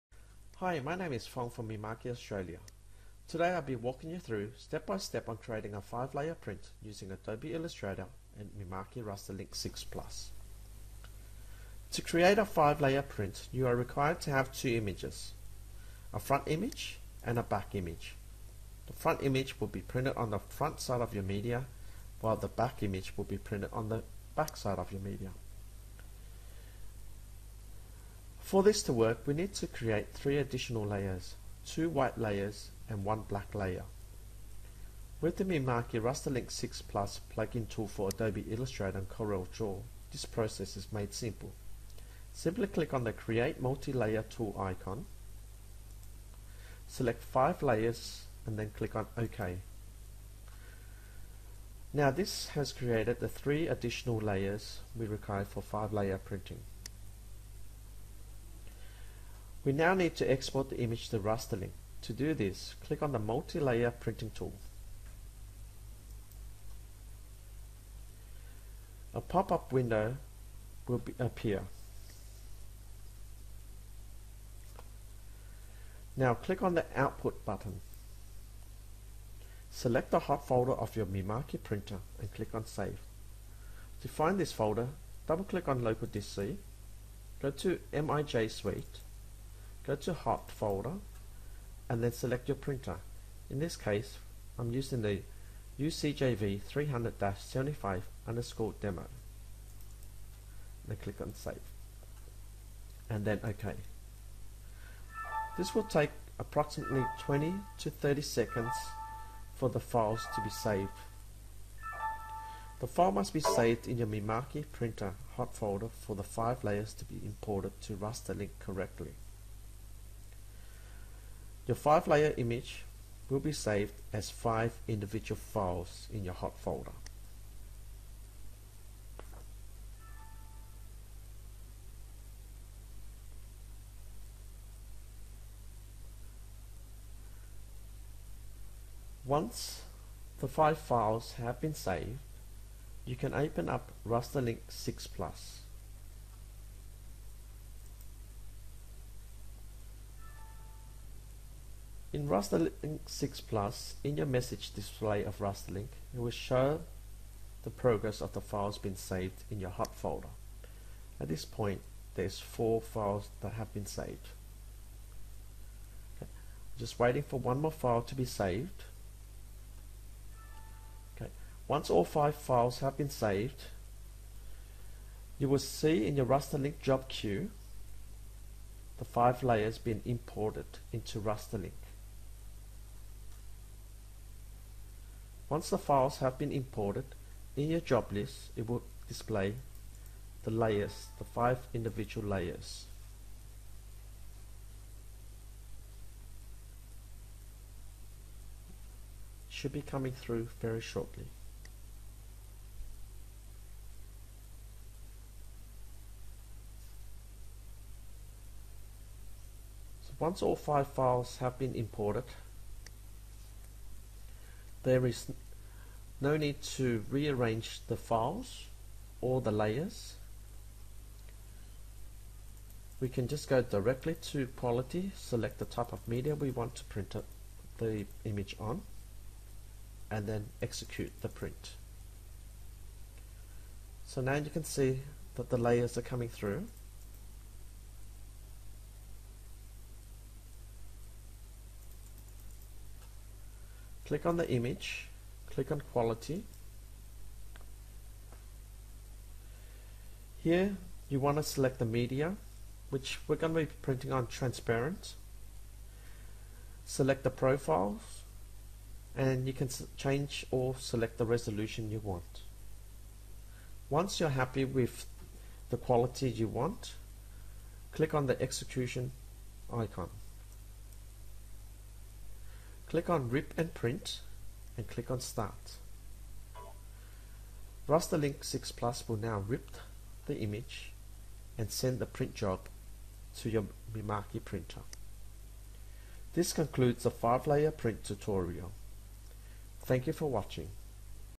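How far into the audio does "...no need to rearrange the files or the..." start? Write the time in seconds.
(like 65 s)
216 s.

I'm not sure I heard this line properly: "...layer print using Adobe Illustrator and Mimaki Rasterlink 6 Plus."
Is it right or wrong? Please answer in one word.
right.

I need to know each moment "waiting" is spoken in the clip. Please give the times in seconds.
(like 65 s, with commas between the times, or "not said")
166 s.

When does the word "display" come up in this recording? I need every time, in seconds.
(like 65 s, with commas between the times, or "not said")
154 s, 189 s.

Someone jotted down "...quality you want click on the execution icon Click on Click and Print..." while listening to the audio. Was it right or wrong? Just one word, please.
wrong.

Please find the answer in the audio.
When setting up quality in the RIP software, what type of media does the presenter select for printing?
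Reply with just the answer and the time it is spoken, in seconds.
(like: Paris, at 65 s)
Transparent, at 254 s.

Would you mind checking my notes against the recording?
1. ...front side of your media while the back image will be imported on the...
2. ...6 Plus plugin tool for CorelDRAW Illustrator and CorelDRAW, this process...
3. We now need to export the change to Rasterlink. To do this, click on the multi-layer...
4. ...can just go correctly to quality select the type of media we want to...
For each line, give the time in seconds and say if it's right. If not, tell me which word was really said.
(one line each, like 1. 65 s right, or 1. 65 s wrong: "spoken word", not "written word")
1. 20 s wrong: "printed", not "imported"
2. 36 s wrong: "Adobe", not "CorelDRAW"
3. 59 s wrong: "image", not "change"
4. 223 s wrong: "directly", not "correctly".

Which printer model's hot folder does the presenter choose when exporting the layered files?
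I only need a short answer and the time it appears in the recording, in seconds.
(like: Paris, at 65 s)
UCJV 300-75, at 95 s.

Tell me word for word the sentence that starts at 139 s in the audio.
Once the five files have been saved, you can open up Rasterlink 6 Plus.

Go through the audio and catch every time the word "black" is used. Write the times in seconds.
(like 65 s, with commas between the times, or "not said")
33 s.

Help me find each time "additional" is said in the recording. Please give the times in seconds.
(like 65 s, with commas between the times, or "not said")
30 s, 53 s.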